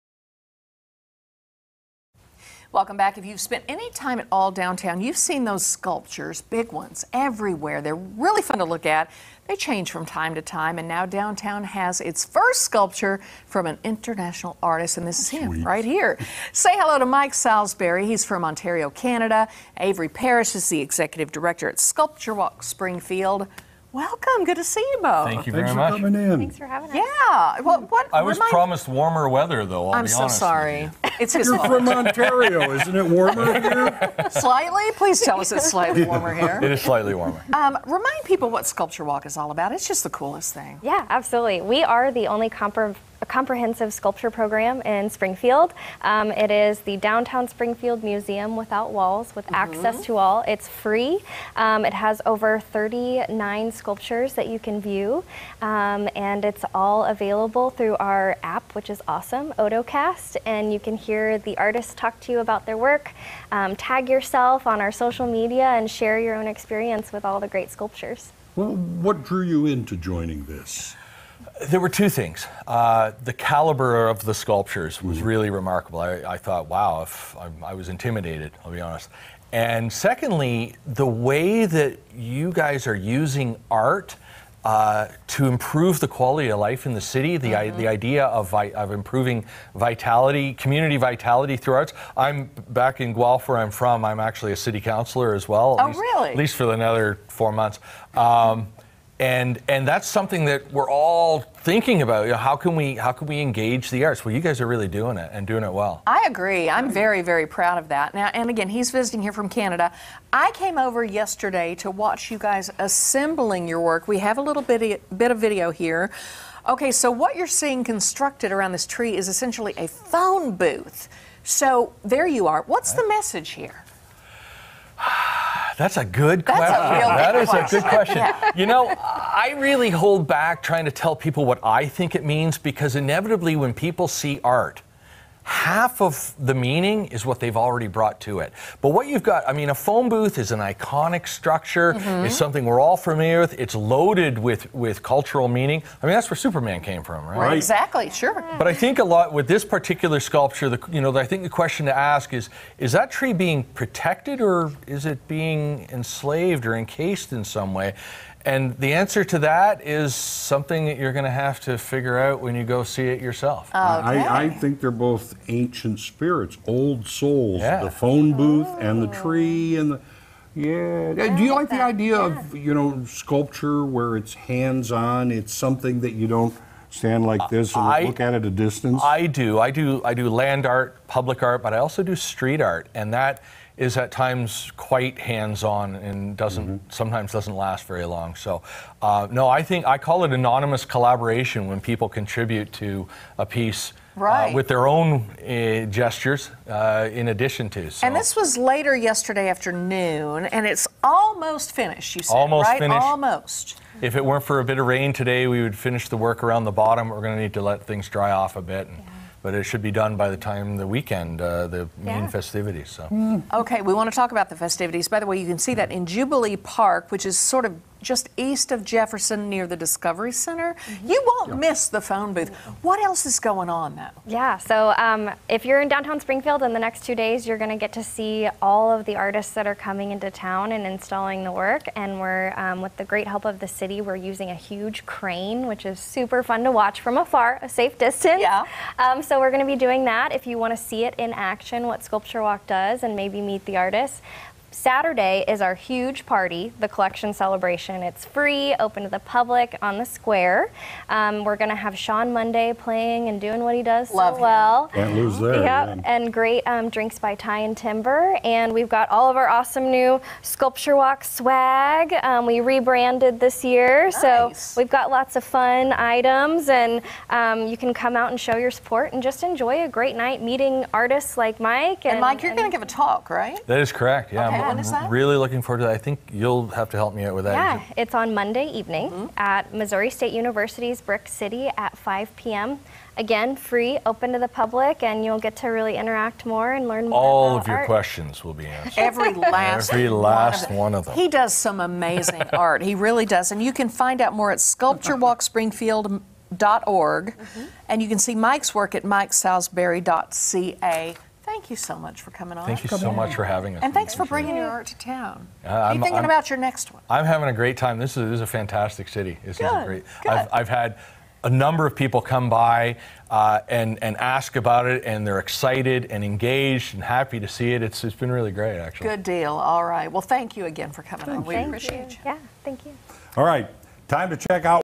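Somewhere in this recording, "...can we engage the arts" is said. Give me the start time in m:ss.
1:43.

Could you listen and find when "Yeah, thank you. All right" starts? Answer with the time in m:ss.
5:22.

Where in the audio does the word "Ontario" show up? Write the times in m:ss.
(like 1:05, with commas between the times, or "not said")
0:18, 0:31.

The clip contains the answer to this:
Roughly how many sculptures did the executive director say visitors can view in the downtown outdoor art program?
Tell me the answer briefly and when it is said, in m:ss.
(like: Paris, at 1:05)
39, at 0:52.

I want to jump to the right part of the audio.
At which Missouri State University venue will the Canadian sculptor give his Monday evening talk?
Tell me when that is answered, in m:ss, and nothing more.
4:41.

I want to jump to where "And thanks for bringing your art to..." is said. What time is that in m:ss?
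5:03.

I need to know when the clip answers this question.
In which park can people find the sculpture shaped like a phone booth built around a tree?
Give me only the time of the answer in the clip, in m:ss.
3:36.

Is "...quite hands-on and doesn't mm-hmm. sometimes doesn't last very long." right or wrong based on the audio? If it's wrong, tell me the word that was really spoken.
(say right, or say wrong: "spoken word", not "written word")
right.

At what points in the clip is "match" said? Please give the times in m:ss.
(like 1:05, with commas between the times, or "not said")
not said.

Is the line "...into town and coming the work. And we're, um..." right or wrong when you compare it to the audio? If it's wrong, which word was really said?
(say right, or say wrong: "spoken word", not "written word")
wrong: "installing", not "coming".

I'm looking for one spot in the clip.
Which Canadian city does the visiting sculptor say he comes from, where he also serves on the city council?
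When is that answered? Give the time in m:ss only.
1:33.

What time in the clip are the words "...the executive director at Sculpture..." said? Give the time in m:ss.
0:20.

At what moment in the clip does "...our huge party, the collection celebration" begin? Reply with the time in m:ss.
4:05.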